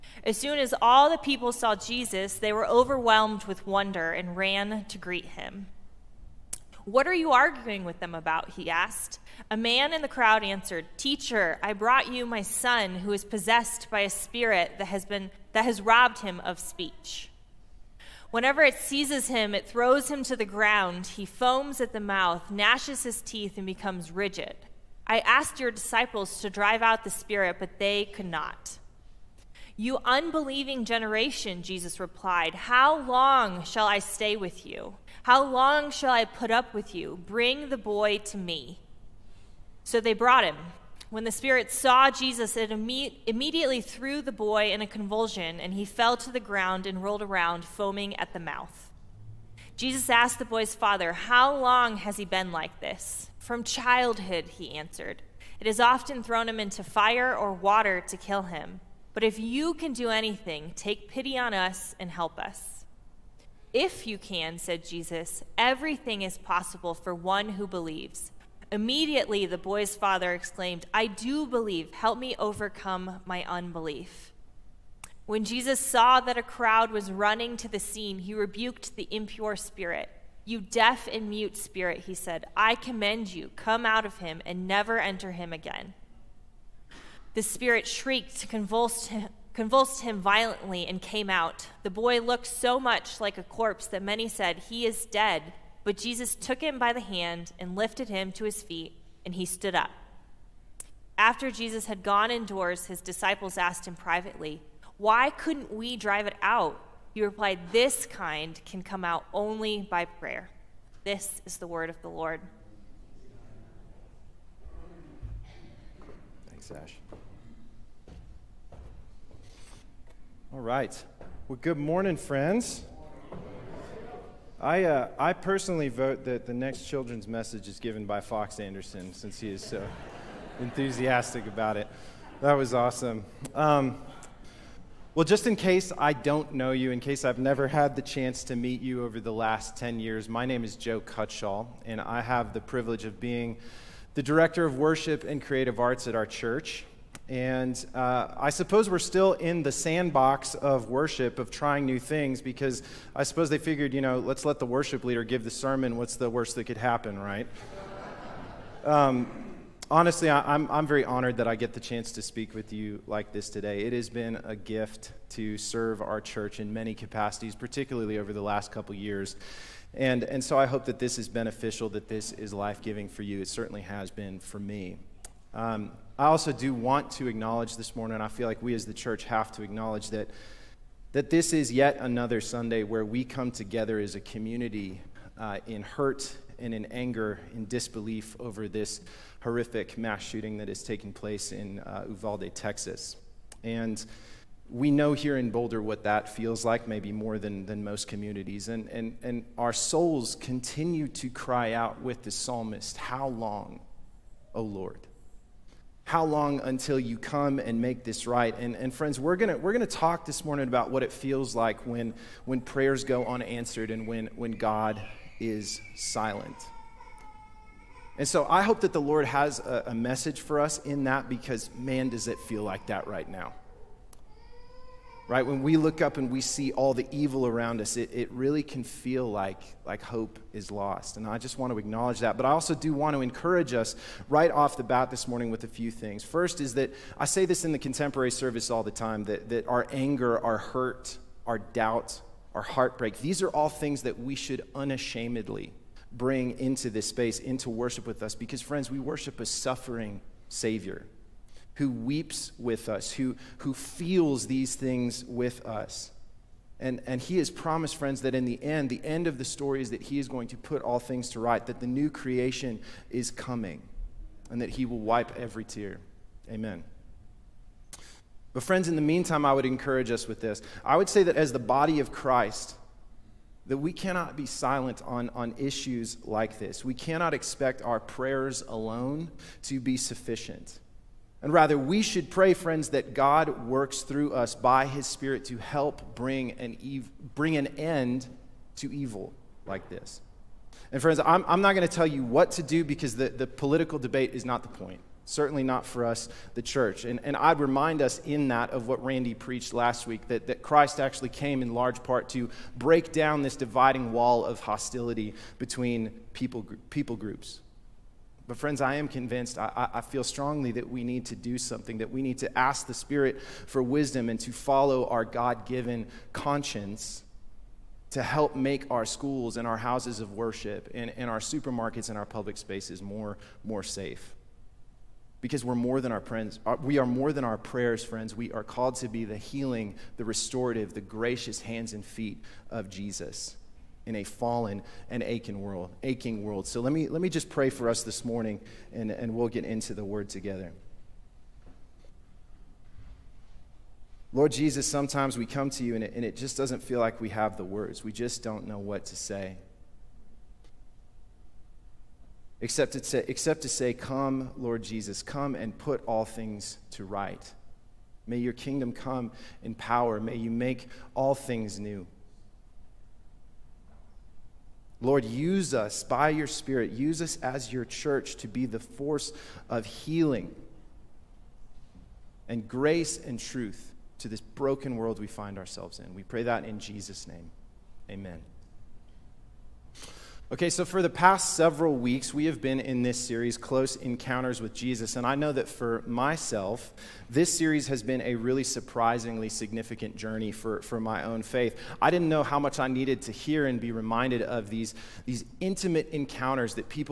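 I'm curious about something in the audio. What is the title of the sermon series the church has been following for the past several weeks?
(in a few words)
Close Encounters with Jesus.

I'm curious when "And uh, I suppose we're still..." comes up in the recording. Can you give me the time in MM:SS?
02:27.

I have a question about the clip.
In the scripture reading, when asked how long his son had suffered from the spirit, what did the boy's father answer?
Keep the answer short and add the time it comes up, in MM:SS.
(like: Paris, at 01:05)
From childhood, at 00:53.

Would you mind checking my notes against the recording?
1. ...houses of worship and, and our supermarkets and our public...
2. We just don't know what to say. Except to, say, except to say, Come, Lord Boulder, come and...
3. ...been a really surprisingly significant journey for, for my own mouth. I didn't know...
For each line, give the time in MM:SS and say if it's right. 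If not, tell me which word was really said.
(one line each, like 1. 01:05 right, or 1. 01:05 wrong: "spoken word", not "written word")
1. 05:19 right
2. 05:48 wrong: "Jesus", not "Boulder"
3. 06:28 wrong: "faith", not "mouth".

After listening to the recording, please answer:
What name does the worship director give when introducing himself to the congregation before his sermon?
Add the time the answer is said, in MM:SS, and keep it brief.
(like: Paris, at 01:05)
Joe Cutshall, at 02:20.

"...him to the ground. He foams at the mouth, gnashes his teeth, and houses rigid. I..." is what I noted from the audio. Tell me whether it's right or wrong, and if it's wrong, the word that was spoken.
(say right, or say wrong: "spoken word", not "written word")
wrong: "becomes", not "houses".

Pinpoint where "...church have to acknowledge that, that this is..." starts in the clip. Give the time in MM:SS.
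02:58.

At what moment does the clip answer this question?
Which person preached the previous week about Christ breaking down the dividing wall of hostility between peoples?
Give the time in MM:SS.
04:59.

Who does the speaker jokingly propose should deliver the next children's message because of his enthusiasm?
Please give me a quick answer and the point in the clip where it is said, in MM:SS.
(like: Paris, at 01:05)
Fox Anderson, at 02:08.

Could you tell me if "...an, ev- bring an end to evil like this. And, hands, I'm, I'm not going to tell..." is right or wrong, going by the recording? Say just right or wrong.
wrong.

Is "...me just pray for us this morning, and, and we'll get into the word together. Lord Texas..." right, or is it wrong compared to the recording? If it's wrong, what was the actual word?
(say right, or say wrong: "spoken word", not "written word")
wrong: "Jesus", not "Texas".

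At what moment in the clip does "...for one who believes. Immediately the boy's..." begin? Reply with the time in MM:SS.
01:06.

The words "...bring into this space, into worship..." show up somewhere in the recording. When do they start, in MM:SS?
04:06.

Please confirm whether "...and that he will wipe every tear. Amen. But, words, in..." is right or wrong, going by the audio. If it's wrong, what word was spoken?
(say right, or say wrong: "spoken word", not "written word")
wrong: "friends", not "words".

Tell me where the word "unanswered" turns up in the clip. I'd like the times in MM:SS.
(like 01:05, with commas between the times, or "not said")
03:33.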